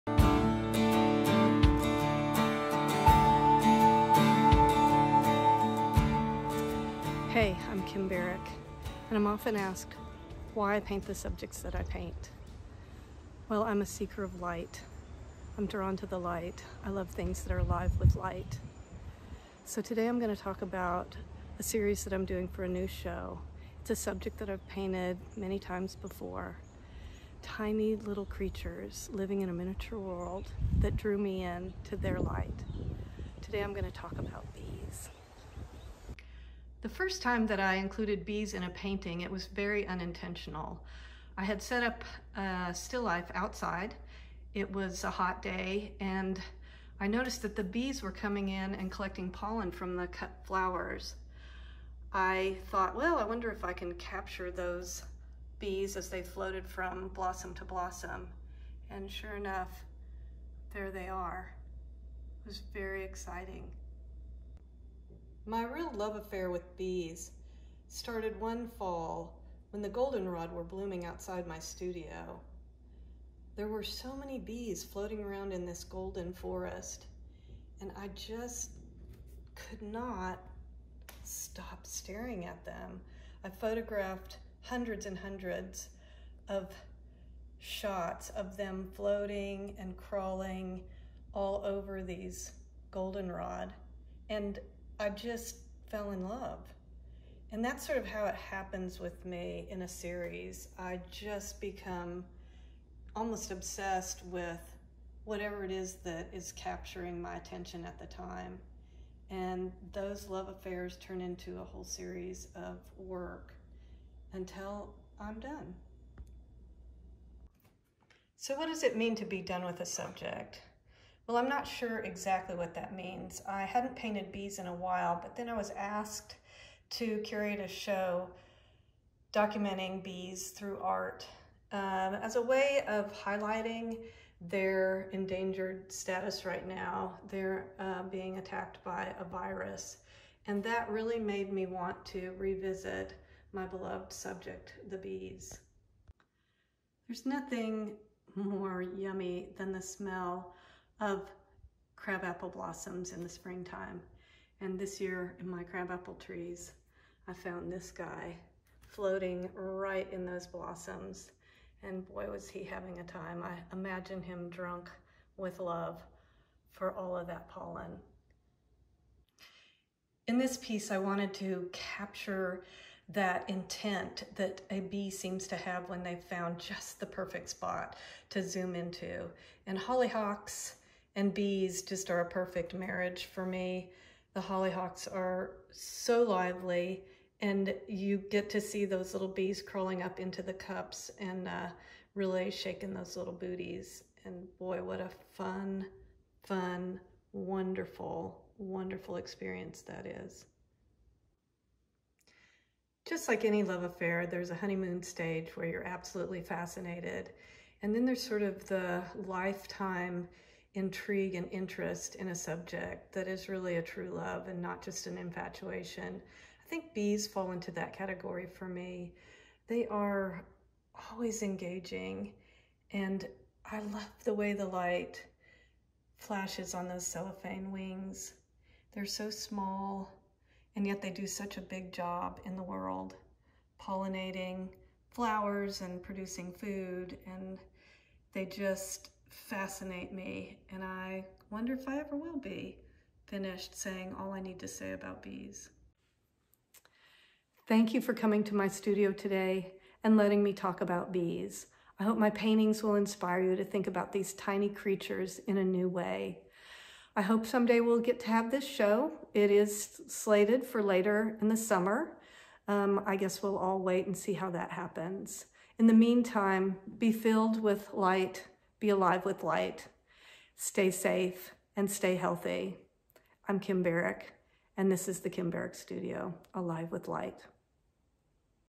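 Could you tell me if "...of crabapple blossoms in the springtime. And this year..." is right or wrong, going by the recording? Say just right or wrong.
right.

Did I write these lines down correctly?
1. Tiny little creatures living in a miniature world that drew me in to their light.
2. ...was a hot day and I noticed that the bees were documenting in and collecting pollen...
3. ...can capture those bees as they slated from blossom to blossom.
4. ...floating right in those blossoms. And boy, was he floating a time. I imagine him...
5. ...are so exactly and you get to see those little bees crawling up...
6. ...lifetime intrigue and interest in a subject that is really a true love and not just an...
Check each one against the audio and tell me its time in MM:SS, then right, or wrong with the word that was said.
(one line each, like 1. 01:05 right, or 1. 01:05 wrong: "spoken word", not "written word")
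1. 00:27 right
2. 00:44 wrong: "coming", not "documenting"
3. 00:53 wrong: "floated", not "slated"
4. 02:38 wrong: "having", not "floating"
5. 03:05 wrong: "lively", not "exactly"
6. 03:29 right.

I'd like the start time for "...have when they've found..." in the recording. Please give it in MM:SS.
02:55.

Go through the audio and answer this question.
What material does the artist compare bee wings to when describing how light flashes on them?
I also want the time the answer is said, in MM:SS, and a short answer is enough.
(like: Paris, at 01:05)
Cellophane, at 03:47.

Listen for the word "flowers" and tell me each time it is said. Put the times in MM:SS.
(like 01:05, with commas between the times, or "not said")
00:50, 03:55.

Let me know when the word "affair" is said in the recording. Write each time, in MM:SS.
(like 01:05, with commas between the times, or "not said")
01:06, 01:50, 03:23.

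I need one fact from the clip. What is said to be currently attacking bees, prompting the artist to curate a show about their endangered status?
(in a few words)
A virus.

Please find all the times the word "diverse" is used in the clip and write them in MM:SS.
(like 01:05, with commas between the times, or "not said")
not said.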